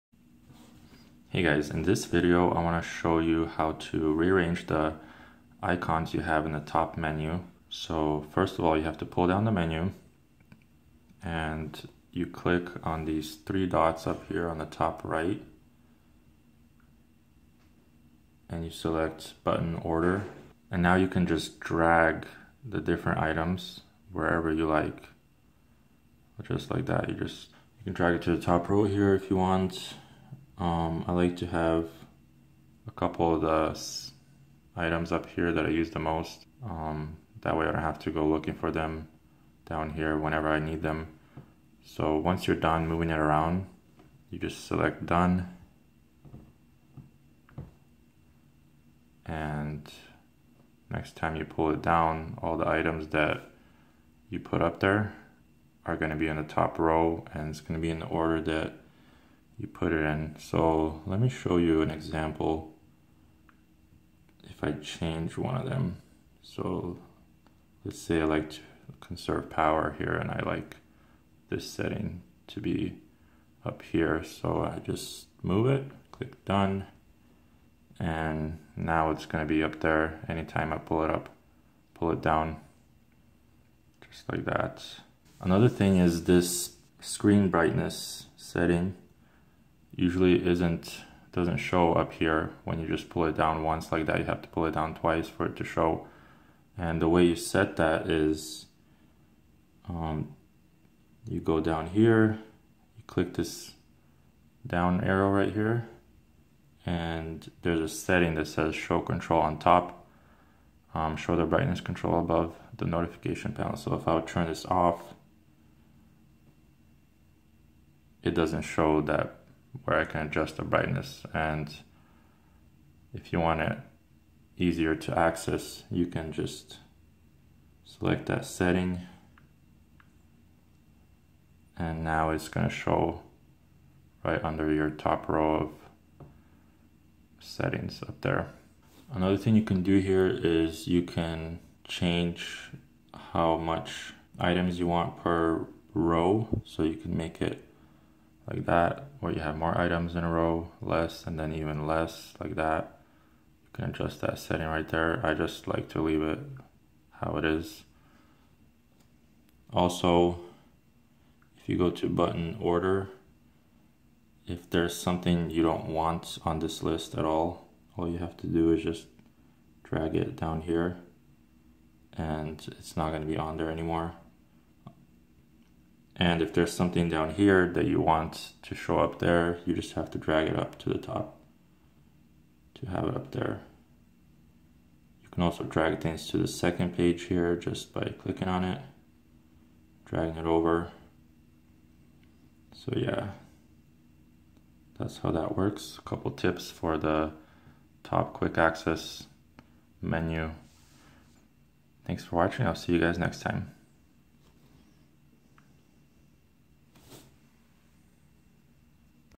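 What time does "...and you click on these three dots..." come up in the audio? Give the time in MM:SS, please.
00:11.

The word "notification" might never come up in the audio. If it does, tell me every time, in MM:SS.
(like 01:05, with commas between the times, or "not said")
01:52.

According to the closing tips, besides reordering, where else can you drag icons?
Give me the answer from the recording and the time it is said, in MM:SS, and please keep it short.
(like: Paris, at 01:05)
The second page, at 03:06.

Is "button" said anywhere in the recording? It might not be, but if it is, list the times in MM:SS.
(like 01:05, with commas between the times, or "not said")
00:19, 02:42.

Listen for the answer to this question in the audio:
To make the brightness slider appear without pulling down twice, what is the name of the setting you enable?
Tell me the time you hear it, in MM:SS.
01:48.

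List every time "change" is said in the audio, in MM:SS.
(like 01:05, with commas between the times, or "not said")
01:04, 02:21.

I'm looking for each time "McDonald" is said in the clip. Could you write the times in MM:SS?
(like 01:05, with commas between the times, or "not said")
not said.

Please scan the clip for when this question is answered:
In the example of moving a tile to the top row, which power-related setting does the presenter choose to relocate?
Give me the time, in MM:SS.
01:09.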